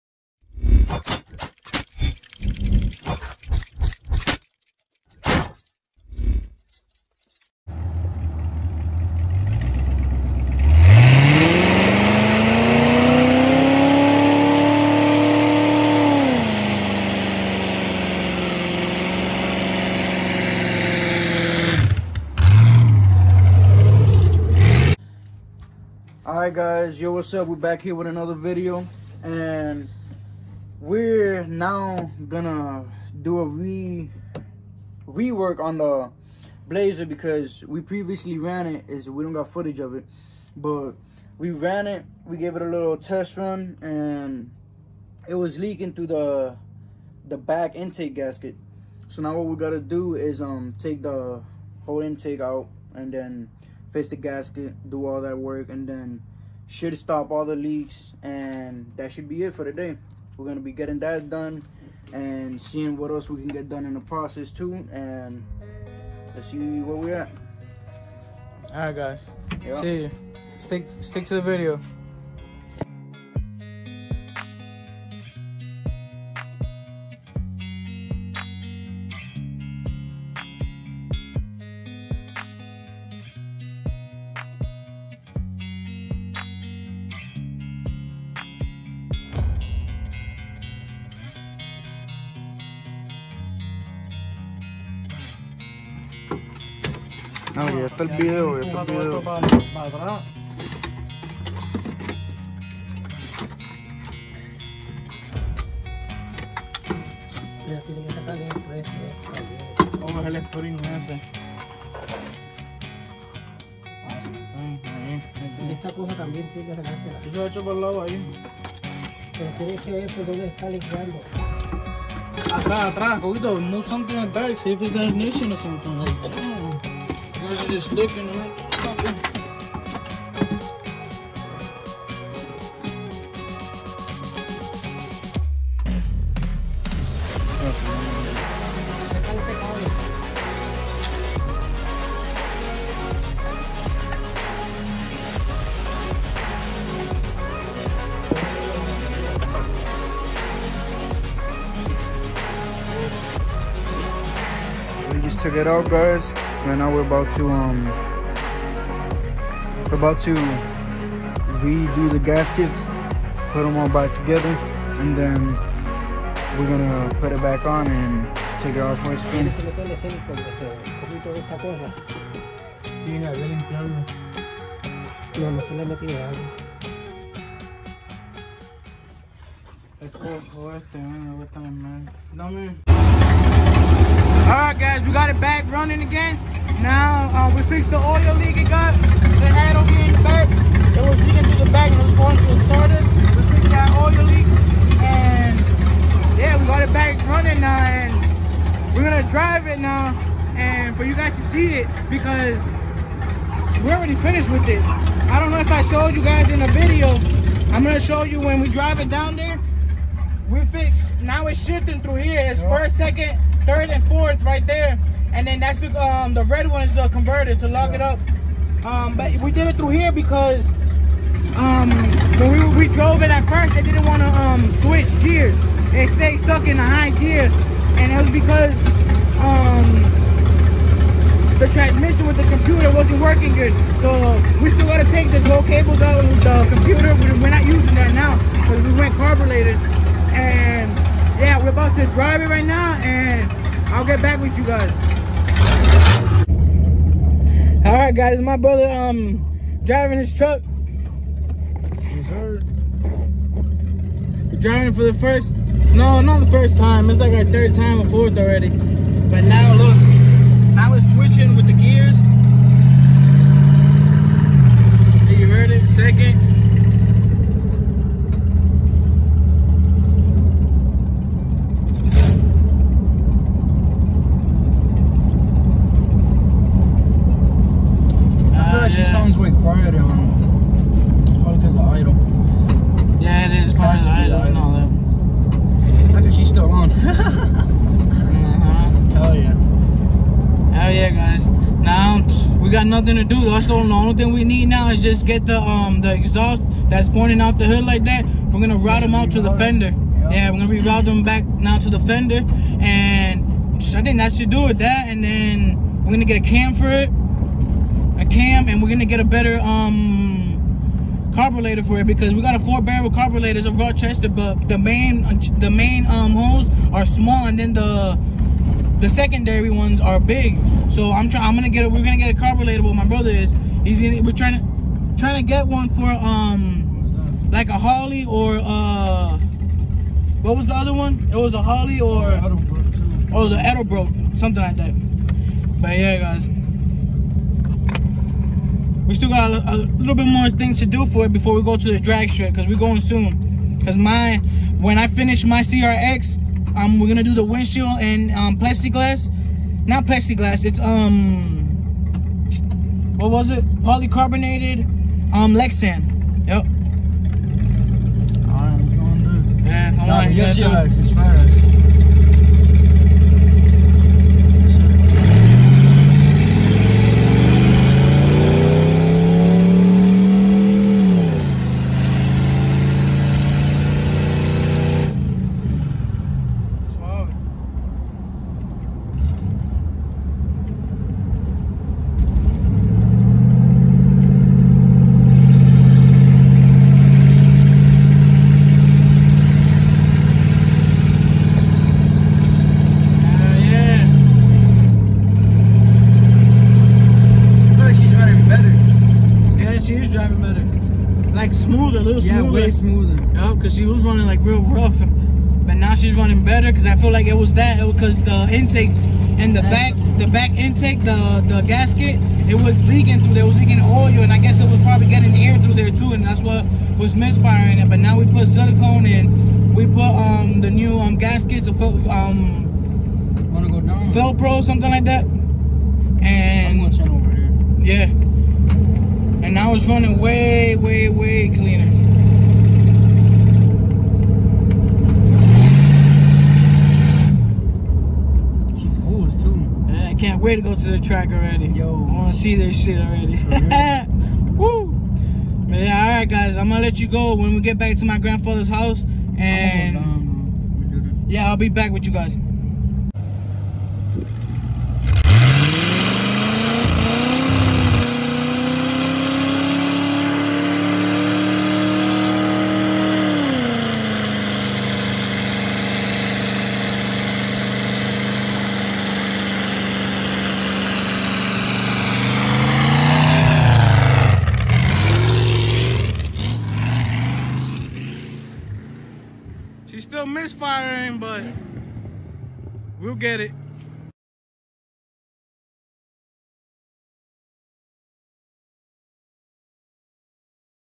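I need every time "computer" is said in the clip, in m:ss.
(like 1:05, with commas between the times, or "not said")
3:52, 3:56.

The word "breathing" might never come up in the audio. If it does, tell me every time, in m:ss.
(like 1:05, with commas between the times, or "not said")
not said.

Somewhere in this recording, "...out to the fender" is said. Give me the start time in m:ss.
4:59.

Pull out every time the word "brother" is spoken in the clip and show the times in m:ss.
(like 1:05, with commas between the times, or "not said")
4:08, 5:23.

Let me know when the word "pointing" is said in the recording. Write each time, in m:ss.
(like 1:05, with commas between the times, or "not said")
4:57.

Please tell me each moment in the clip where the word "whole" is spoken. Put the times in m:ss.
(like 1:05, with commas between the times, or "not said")
0:51, 3:55.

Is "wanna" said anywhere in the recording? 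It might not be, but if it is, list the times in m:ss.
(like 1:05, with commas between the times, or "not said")
7:03, 7:22.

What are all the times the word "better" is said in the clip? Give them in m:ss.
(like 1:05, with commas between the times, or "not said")
5:09, 6:40, 6:46.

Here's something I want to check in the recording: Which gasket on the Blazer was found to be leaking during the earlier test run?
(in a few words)
Back intake gasket.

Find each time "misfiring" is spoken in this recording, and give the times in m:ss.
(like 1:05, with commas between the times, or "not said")
6:57, 8:00.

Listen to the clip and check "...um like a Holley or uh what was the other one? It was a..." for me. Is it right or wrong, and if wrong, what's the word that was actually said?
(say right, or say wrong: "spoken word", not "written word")
right.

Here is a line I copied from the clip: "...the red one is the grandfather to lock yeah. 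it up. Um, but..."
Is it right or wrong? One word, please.
wrong.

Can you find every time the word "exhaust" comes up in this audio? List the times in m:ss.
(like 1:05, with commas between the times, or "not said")
4:56.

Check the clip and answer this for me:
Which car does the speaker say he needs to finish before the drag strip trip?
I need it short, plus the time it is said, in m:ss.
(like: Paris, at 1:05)
CRX, at 5:45.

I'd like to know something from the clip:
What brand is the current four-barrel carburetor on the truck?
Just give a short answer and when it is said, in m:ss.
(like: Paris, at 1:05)
Rochester, at 5:13.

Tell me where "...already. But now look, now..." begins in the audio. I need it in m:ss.
4:18.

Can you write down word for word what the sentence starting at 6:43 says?
Yeah, because she was running like real rough.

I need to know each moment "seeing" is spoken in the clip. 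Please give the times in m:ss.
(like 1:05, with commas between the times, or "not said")
1:02.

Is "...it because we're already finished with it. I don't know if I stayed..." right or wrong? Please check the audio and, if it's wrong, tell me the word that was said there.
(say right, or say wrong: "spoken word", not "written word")
wrong: "showed", not "stayed".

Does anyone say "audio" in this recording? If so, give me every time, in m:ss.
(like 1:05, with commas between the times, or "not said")
not said.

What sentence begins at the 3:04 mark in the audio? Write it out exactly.
Alright guys, we got it back running again.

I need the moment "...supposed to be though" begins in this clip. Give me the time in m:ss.
4:43.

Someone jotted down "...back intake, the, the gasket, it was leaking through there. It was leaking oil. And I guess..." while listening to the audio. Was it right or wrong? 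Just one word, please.
right.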